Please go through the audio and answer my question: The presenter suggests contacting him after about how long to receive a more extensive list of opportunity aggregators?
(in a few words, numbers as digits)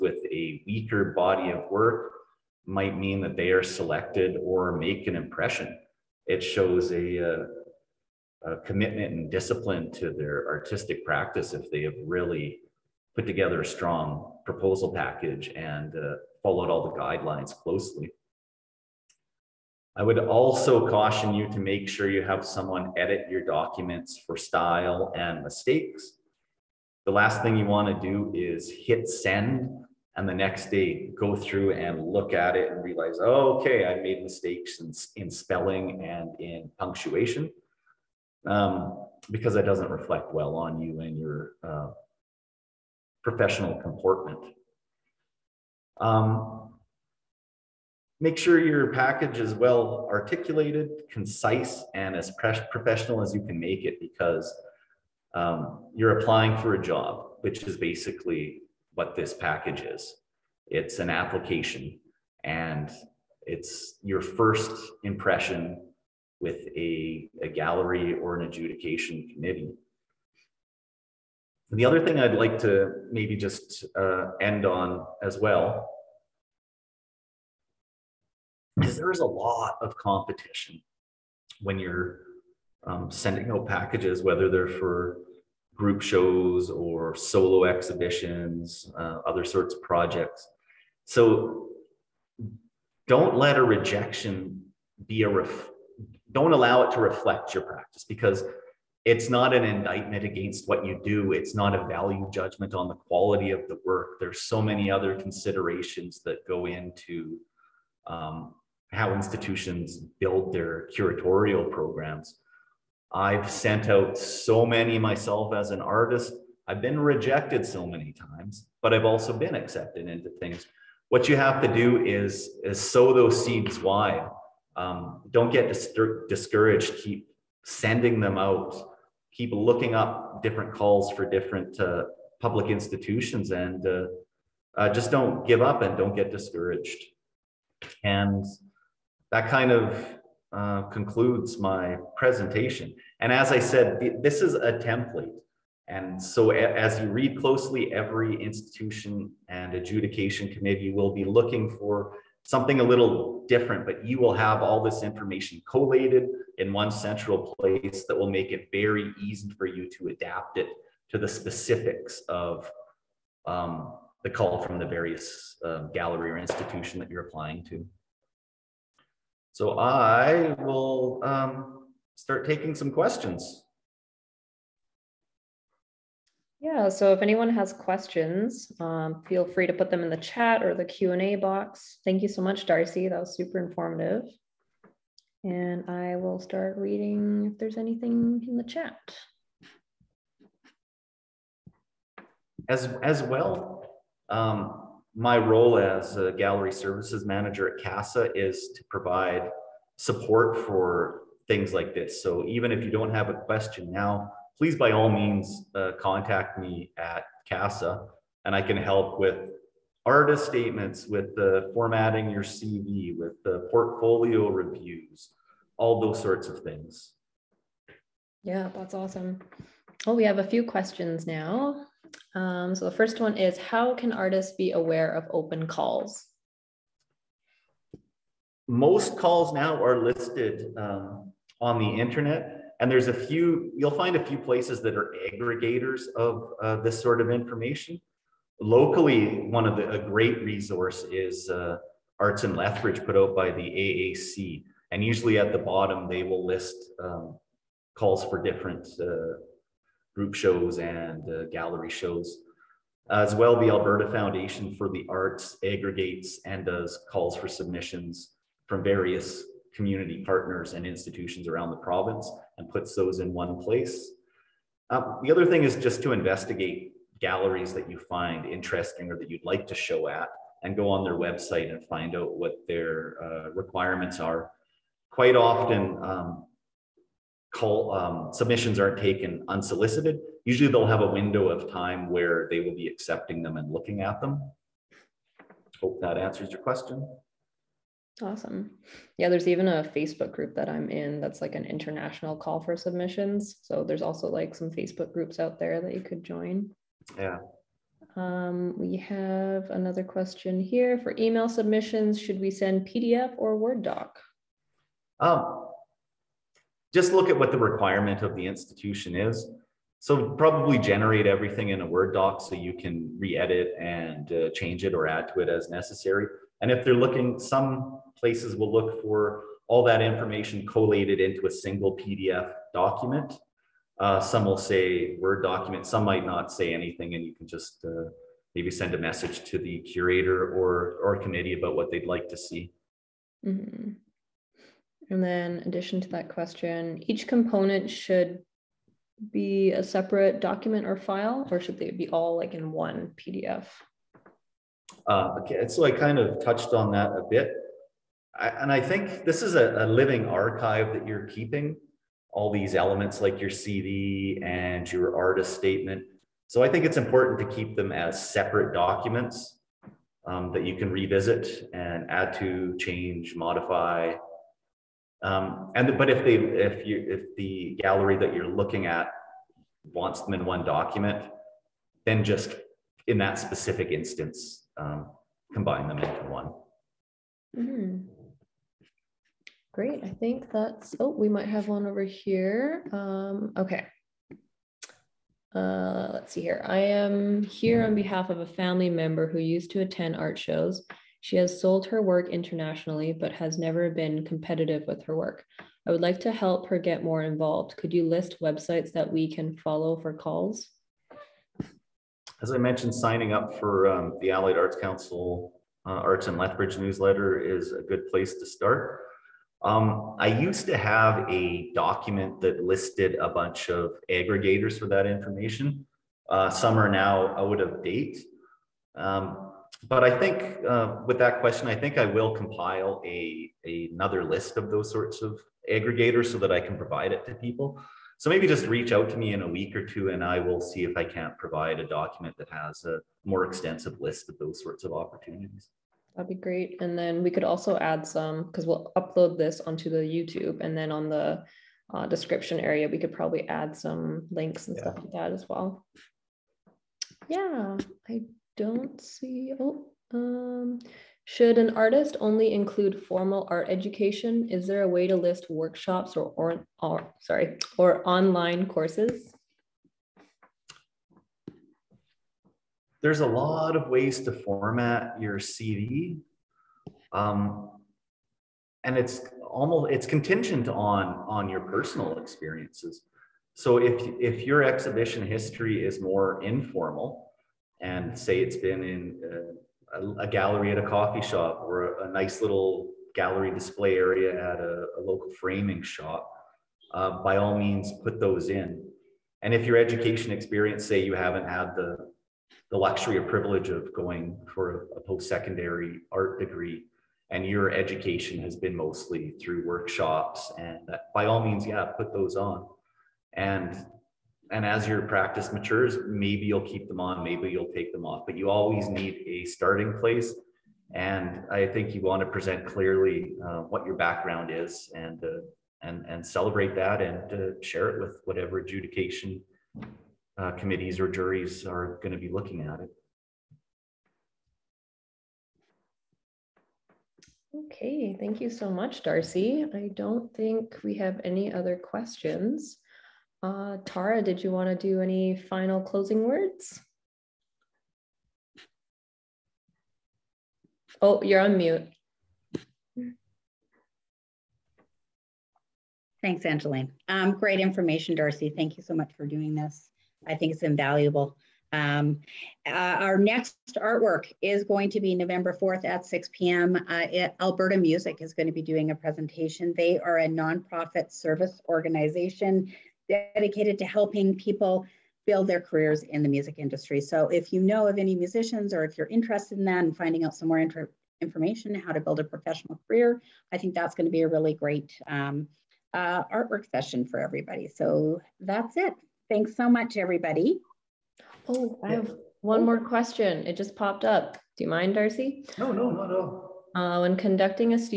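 a week or two.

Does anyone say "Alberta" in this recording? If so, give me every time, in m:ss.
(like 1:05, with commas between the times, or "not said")
4:13, 9:17.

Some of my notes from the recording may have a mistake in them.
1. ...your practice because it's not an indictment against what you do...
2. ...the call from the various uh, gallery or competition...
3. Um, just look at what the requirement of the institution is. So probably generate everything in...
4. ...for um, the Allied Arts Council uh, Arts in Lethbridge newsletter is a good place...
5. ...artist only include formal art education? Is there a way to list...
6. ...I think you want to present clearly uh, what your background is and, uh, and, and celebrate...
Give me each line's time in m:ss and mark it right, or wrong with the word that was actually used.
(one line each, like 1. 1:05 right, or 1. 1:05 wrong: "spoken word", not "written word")
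1. 1:37 right
2. 2:44 wrong: "institution", not "competition"
3. 5:05 right
4. 6:43 right
5. 7:31 right
6. 8:31 right.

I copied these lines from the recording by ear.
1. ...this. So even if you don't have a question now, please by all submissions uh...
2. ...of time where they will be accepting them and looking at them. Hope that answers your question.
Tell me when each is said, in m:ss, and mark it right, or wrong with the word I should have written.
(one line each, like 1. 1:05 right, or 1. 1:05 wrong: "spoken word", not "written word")
1. 3:21 wrong: "means", not "submissions"
2. 4:41 right.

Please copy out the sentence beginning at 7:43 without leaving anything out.
There's a lot of ways to format your CV.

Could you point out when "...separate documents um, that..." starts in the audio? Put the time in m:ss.
5:58.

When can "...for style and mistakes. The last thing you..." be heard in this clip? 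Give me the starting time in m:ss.
0:24.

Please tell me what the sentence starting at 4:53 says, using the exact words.
So there's also like some Facebook groups out there that you could join.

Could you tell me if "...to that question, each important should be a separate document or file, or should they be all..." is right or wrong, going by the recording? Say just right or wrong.
wrong.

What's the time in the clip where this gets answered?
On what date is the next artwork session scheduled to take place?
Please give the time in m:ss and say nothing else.
9:15.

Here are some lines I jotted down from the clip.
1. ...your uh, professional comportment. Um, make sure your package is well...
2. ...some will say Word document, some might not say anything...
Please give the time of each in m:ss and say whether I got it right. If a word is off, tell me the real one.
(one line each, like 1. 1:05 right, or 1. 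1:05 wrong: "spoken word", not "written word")
1. 0:41 right
2. 5:24 right.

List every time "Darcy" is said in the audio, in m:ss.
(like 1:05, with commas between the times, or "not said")
3:02, 8:49, 9:08, 9:44.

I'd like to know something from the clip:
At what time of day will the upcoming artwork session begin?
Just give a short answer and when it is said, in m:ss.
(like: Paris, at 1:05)
6 p.m., at 9:16.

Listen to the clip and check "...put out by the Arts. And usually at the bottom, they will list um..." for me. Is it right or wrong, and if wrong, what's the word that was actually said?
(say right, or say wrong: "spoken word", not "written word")
wrong: "AAC", not "Arts".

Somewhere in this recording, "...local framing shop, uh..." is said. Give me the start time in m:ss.
8:05.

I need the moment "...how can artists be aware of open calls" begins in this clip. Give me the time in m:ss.
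3:43.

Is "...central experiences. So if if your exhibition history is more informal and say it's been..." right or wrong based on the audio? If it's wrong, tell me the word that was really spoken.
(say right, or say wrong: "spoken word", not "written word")
wrong: "personal", not "central".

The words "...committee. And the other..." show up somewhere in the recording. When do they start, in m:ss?
1:09.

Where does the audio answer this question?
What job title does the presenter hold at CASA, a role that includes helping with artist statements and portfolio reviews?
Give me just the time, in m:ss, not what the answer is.
3:16.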